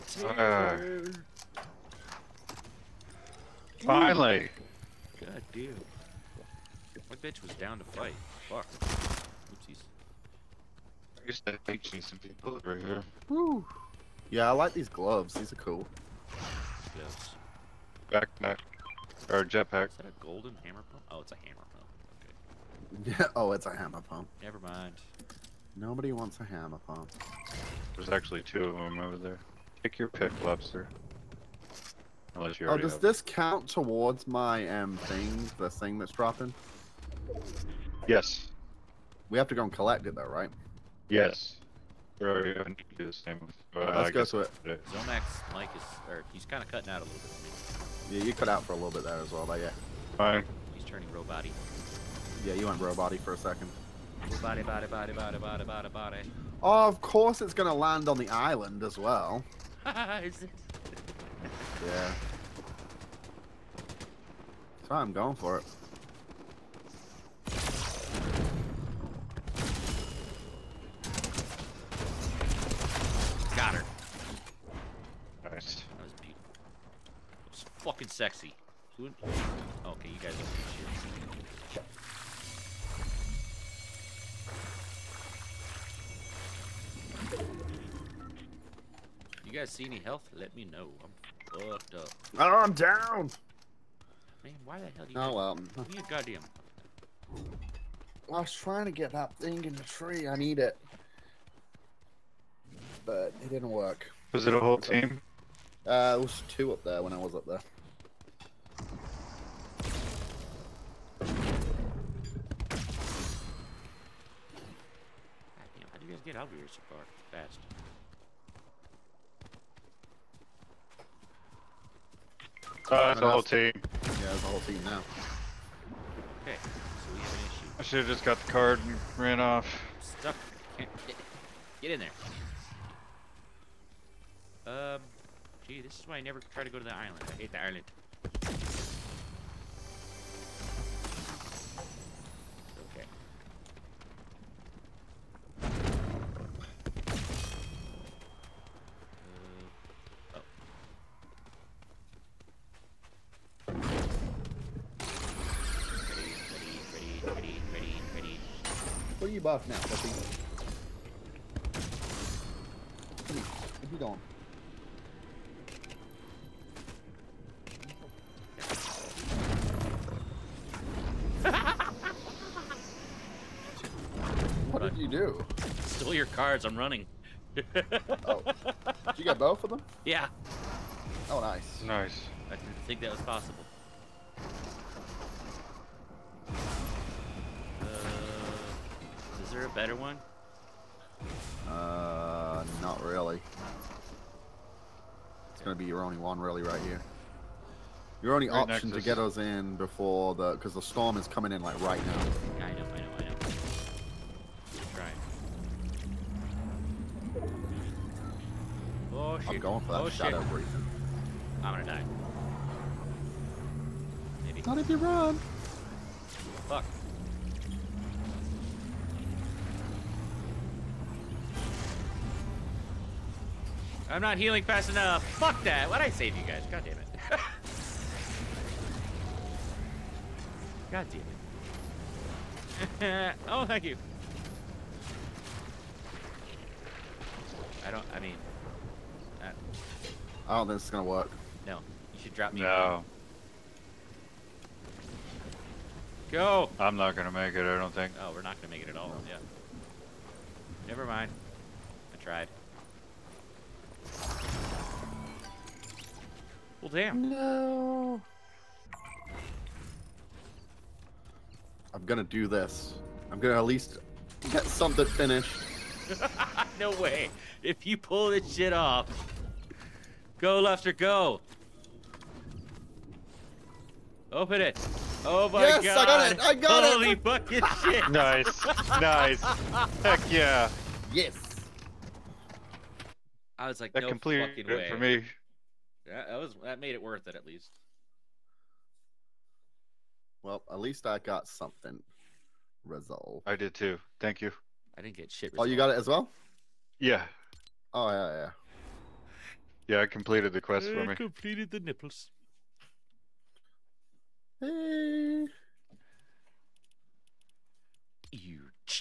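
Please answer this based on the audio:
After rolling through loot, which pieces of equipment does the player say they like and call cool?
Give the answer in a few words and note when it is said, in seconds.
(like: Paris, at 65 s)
gloves, at 14 s.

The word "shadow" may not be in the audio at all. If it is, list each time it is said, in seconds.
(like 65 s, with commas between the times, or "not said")
210 s.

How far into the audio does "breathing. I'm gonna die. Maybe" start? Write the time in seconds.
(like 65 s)
210 s.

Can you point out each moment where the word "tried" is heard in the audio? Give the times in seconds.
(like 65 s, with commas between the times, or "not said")
252 s.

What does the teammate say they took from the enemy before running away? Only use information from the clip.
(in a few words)
cards.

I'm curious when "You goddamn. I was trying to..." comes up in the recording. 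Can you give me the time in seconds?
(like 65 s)
95 s.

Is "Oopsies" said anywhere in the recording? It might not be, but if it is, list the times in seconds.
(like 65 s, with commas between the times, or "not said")
8 s.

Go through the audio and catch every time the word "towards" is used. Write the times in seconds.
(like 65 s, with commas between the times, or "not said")
33 s.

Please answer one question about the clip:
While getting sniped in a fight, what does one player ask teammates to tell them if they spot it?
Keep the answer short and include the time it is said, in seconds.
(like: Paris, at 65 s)
health, at 89 s.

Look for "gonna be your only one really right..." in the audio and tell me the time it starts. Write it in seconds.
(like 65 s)
195 s.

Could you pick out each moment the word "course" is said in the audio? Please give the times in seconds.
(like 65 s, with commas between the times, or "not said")
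57 s.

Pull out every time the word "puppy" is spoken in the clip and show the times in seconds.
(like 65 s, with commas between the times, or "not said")
159 s.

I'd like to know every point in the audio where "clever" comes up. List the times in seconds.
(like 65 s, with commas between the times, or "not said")
not said.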